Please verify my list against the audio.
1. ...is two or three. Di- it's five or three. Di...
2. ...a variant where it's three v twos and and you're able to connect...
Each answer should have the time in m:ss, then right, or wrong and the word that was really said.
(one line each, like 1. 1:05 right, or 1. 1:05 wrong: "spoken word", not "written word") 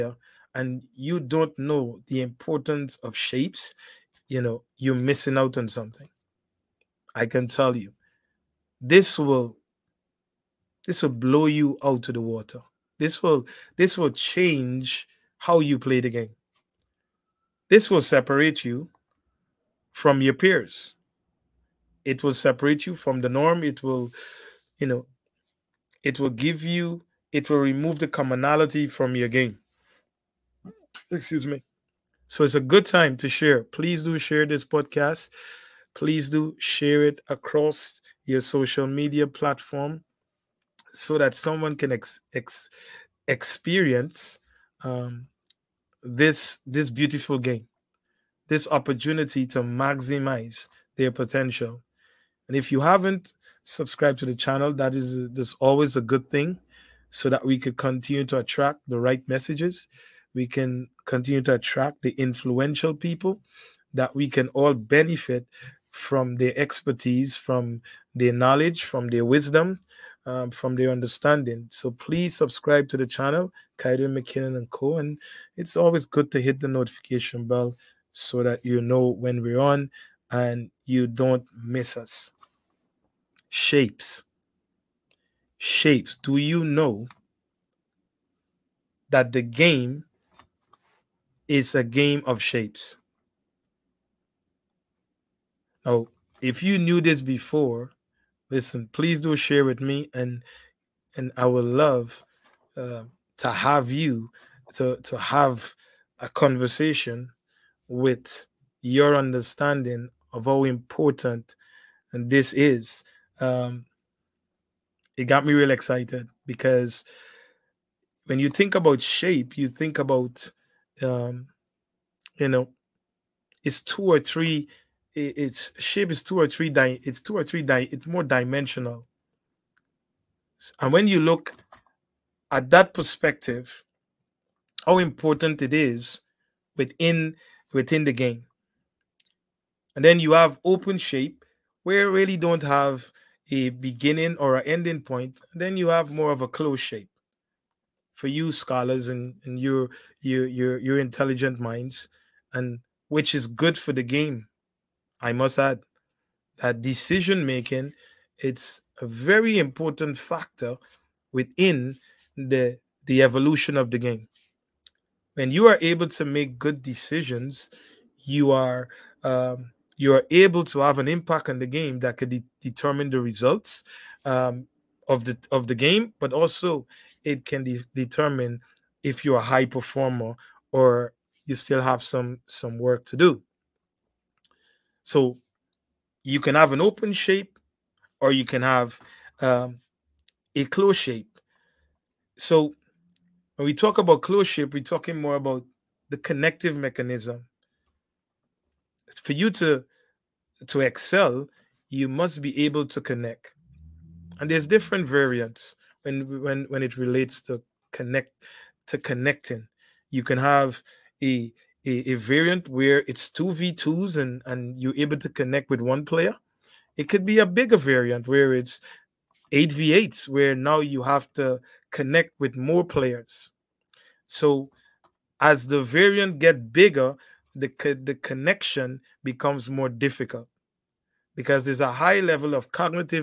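1. 2:06 wrong: "two", not "five"
2. 3:32 wrong: "two", not "three".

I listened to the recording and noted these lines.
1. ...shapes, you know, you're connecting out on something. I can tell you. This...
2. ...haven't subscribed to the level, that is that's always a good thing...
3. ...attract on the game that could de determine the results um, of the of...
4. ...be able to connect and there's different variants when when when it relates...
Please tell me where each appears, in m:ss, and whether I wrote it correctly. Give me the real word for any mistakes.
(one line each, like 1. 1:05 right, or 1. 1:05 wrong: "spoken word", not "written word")
1. 0:03 wrong: "missing", not "connecting"
2. 0:52 wrong: "channel", not "level"
3. 2:51 wrong: "impact", not "attract"
4. 3:22 right.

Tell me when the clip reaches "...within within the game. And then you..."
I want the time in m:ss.
2:16.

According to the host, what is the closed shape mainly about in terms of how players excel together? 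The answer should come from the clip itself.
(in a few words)
The connective mechanism.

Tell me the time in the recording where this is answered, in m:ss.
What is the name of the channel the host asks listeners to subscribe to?
1:13.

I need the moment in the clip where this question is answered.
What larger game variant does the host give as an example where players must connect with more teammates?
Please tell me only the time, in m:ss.
3:39.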